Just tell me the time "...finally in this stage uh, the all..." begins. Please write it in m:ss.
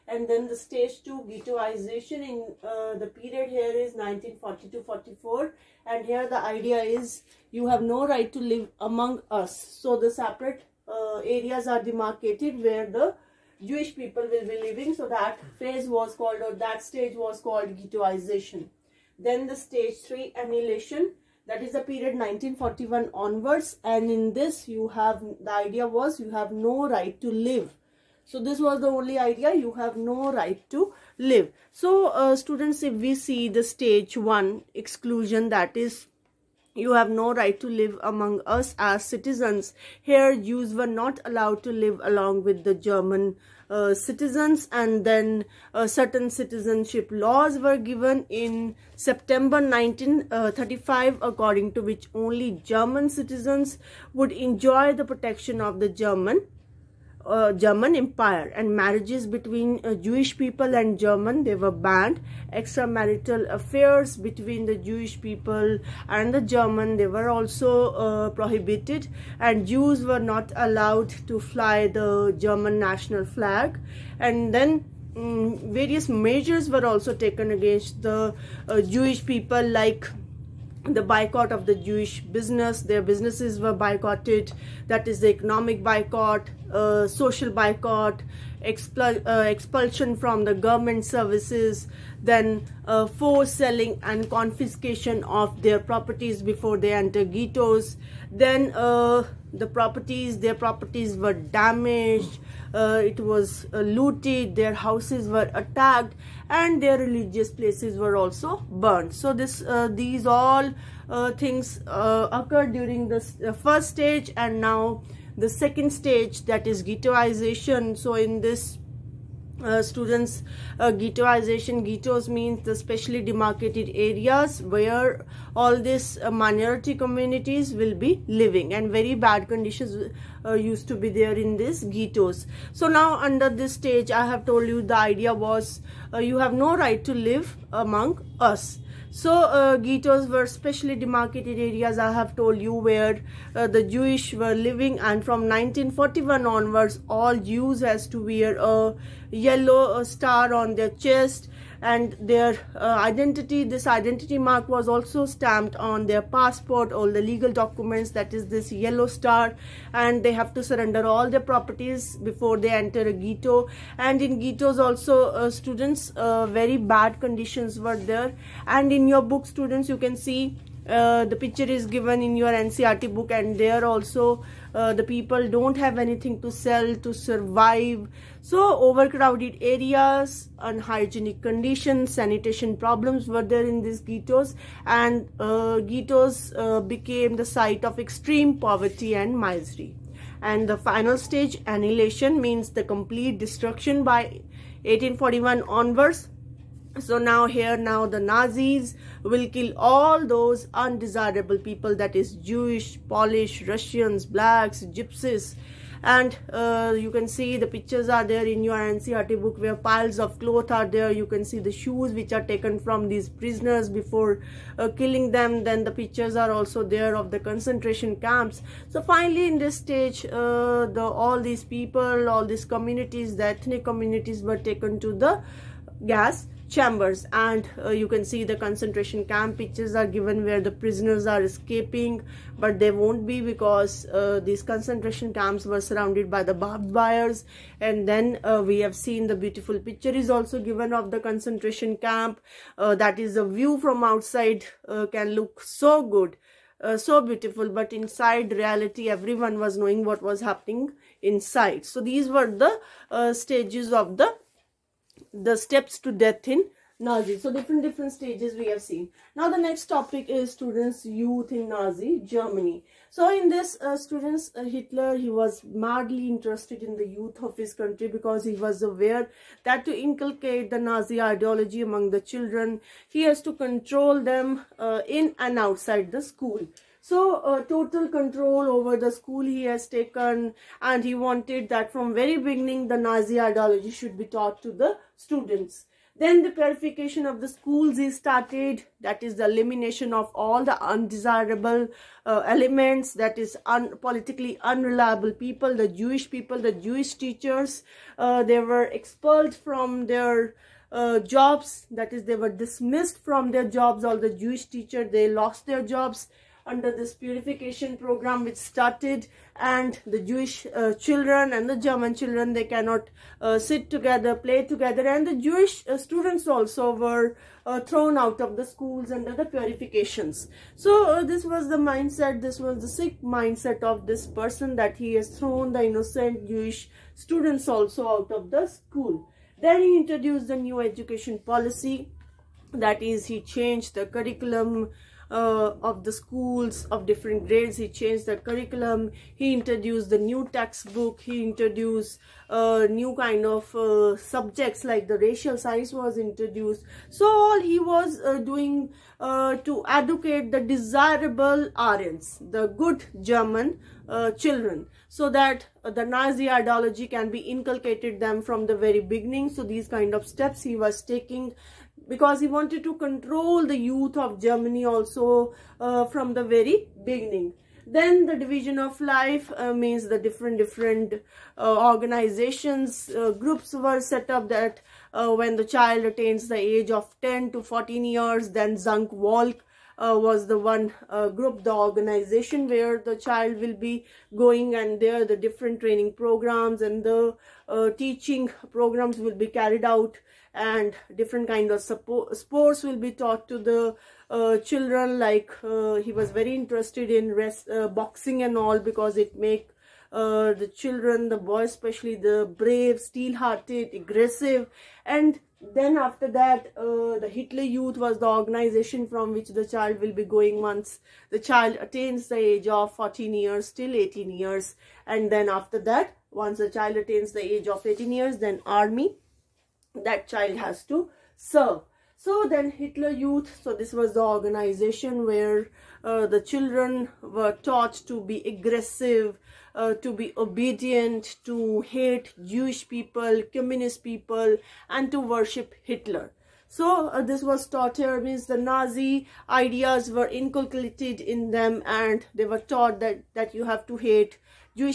3:39.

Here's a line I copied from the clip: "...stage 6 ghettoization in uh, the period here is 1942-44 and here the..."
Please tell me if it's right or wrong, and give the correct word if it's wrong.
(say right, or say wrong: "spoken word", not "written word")
wrong: "2", not "6".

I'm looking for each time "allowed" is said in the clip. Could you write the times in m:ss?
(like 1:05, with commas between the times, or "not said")
0:41, 1:10.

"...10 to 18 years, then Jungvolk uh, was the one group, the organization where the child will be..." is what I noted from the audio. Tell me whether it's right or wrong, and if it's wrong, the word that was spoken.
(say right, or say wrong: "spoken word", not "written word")
wrong: "14", not "18".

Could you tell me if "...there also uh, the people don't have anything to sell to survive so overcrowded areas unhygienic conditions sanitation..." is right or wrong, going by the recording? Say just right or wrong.
right.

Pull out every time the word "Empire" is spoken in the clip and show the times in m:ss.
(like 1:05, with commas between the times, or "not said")
0:57.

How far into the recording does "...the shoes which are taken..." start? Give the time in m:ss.
3:31.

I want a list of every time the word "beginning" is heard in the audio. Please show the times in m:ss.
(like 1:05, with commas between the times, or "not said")
4:42, 5:59, 6:07.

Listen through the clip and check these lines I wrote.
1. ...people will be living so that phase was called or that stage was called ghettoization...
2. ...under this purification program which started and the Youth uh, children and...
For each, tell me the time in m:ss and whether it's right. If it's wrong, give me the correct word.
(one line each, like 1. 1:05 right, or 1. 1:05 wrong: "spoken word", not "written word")
1. 0:13 right
2. 5:06 wrong: "Jewish", not "Youth".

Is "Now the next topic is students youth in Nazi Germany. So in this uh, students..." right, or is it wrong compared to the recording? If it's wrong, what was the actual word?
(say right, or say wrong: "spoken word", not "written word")
right.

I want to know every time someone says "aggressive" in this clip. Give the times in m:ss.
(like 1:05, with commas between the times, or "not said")
6:43, 7:08.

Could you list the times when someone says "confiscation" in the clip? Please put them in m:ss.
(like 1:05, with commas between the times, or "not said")
1:34.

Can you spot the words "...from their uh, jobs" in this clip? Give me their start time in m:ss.
4:59.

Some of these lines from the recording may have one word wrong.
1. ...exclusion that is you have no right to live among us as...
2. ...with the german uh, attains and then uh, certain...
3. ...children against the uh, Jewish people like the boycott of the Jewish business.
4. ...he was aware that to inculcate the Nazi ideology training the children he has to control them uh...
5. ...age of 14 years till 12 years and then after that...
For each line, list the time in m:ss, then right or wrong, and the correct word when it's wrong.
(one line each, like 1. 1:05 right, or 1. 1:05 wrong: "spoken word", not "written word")
1. 0:34 right
2. 0:42 wrong: "citizens", not "attains"
3. 1:17 wrong: "taken", not "children"
4. 4:28 wrong: "among", not "training"
5. 6:52 wrong: "18", not "12".